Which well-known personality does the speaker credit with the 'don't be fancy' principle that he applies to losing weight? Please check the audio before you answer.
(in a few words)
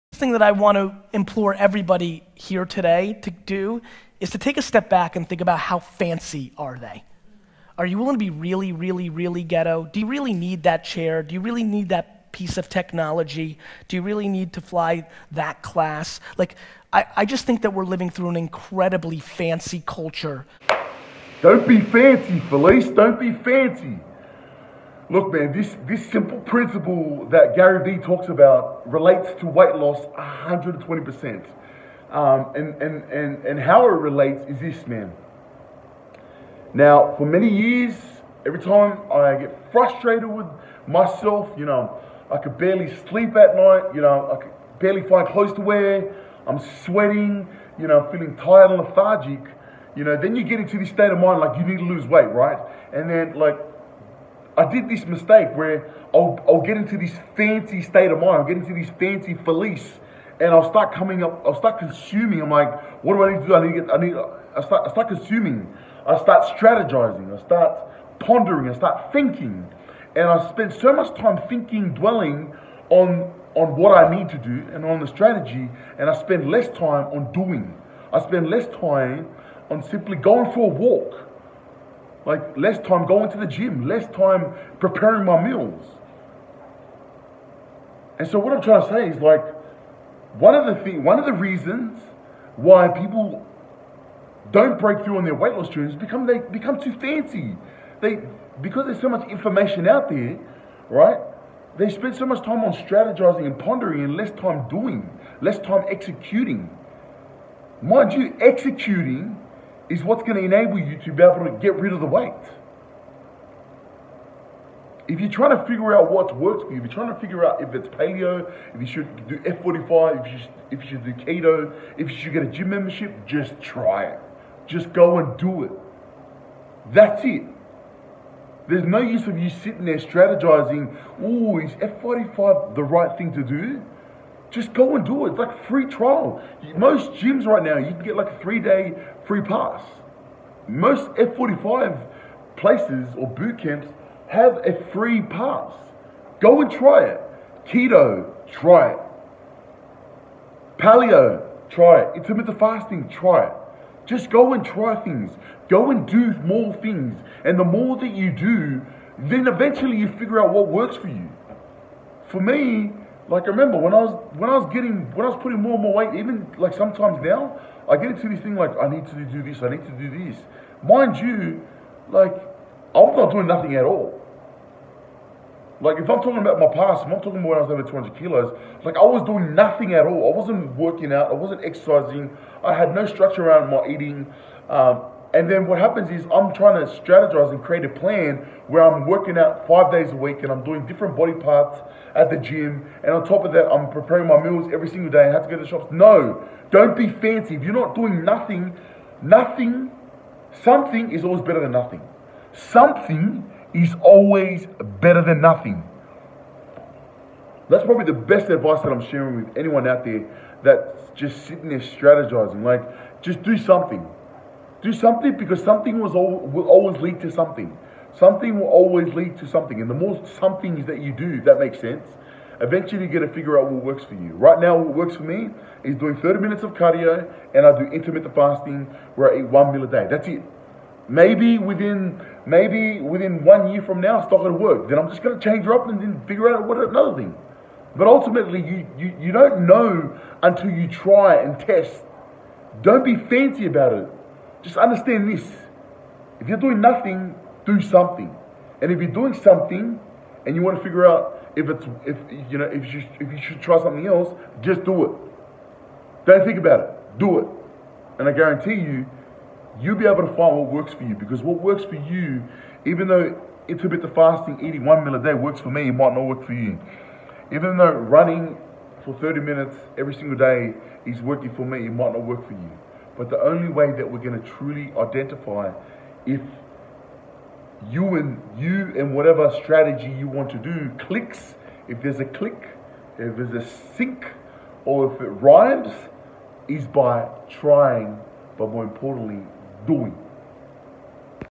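Gary Vee.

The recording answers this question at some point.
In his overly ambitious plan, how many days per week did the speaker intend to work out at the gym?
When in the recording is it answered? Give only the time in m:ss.
3:09.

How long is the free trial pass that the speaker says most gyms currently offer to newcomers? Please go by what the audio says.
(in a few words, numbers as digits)
3 days.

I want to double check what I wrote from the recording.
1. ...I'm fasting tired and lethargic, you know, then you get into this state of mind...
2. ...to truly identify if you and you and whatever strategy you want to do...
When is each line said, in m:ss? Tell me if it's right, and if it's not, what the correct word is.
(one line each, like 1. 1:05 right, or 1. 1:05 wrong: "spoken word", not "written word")
1. 0:48 wrong: "feeling", not "fasting"
2. 4:34 right.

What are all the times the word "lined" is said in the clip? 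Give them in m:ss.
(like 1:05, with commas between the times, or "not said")
not said.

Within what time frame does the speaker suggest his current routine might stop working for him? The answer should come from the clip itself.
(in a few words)
1 year.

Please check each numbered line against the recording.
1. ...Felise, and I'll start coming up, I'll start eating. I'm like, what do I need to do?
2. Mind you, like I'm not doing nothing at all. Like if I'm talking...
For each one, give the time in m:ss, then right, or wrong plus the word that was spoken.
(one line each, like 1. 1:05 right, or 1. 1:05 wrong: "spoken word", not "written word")
1. 0:59 wrong: "consuming", not "eating"
2. 2:50 right.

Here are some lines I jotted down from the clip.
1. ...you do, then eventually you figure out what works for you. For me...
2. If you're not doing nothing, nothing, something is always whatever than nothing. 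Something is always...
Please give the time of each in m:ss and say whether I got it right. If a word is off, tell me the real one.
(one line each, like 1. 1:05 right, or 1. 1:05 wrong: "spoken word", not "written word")
1. 2:38 right
2. 3:17 wrong: "better", not "whatever".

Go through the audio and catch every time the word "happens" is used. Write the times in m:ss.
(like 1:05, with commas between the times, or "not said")
3:05.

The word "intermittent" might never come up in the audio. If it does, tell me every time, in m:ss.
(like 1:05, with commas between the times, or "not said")
2:32, 3:47, 4:23.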